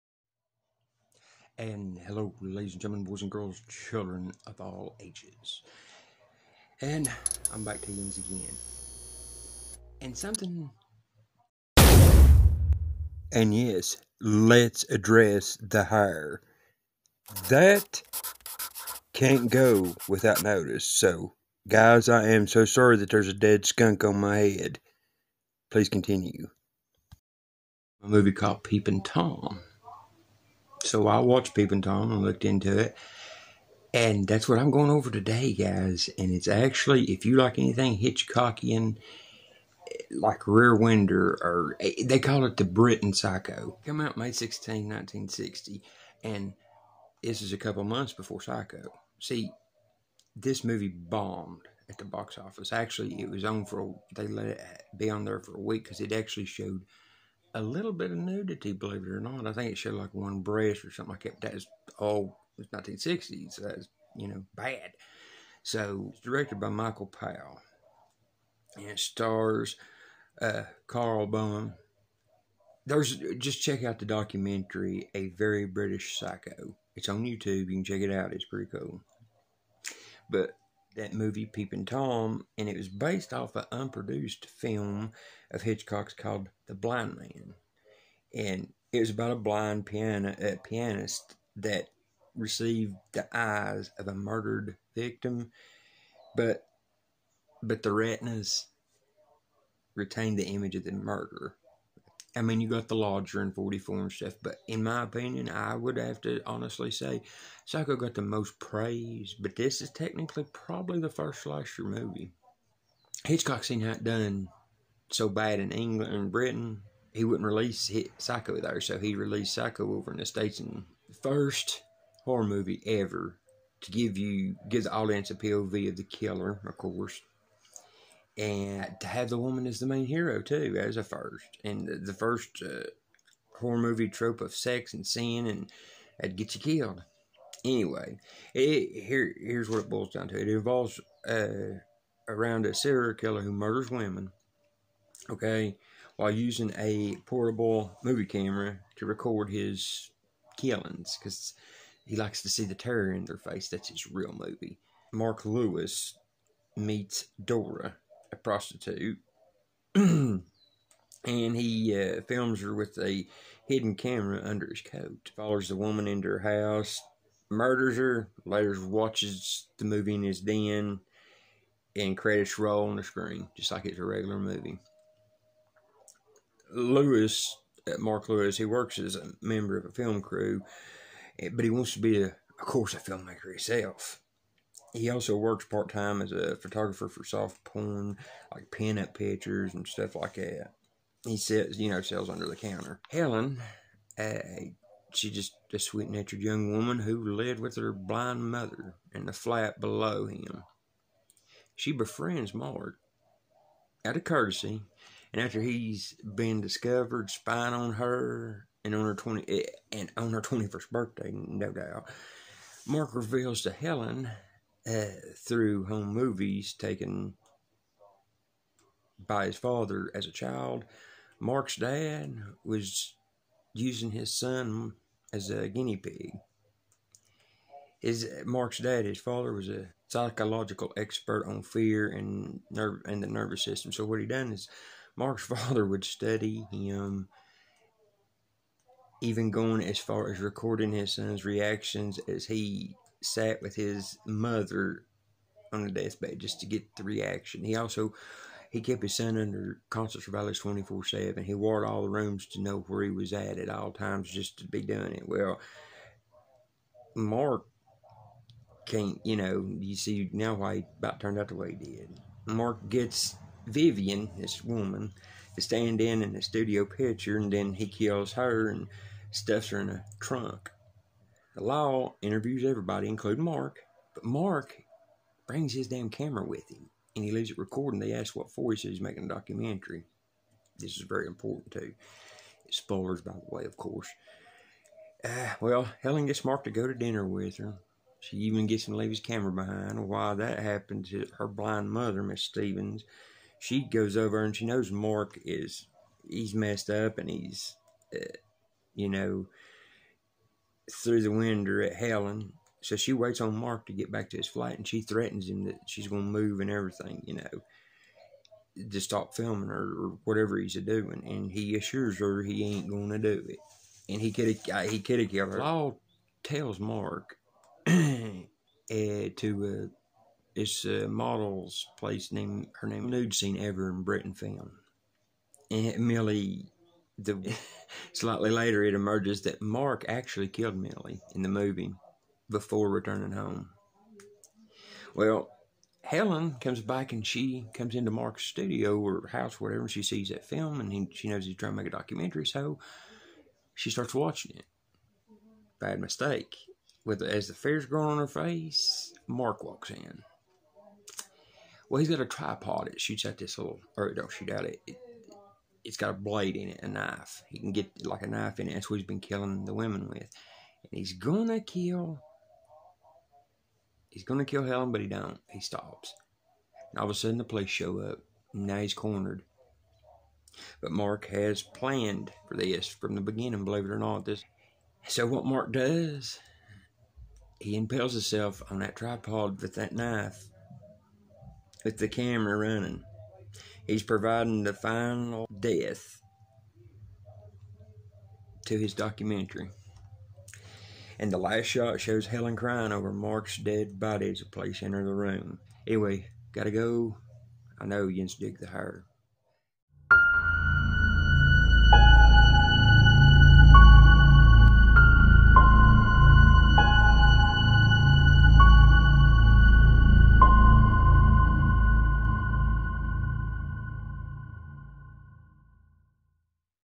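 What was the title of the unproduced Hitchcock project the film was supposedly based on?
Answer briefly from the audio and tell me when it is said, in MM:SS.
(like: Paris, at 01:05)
The Blind Man, at 01:26.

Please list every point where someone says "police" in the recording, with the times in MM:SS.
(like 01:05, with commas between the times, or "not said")
06:07, 06:34.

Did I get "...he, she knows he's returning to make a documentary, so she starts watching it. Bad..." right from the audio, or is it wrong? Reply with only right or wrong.
wrong.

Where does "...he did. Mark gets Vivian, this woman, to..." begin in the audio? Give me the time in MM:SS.
04:21.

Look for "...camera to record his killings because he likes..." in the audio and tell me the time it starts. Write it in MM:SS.
02:28.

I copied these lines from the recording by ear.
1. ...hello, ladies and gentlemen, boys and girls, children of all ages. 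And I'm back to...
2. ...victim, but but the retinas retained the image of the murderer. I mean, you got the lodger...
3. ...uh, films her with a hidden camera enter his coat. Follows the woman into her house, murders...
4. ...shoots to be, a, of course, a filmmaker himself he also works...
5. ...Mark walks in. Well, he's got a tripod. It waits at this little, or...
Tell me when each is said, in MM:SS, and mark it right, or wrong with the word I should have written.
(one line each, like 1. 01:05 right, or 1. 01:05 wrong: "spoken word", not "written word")
1. 00:02 right
2. 01:34 right
3. 02:42 wrong: "under", not "enter"
4. 03:01 wrong: "wants", not "shoots"
5. 05:49 wrong: "shoots", not "waits".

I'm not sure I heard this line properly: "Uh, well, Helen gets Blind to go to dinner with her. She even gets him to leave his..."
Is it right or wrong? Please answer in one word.
wrong.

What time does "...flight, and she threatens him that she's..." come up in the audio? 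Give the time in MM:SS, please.
05:04.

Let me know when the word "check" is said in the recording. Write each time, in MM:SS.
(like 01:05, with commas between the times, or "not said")
01:13, 01:17.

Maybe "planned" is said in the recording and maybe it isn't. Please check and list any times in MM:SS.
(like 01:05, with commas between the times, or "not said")
06:11.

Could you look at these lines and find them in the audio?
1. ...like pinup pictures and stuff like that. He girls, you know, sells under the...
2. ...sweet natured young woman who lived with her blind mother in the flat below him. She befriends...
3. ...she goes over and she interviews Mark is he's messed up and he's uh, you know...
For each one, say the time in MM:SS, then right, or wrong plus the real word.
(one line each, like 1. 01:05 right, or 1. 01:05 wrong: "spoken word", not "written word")
1. 03:08 wrong: "sells", not "girls"
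2. 03:15 right
3. 04:53 wrong: "knows", not "interviews".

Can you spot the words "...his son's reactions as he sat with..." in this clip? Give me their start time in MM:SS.
04:00.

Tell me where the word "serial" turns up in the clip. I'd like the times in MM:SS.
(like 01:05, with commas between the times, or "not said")
02:22.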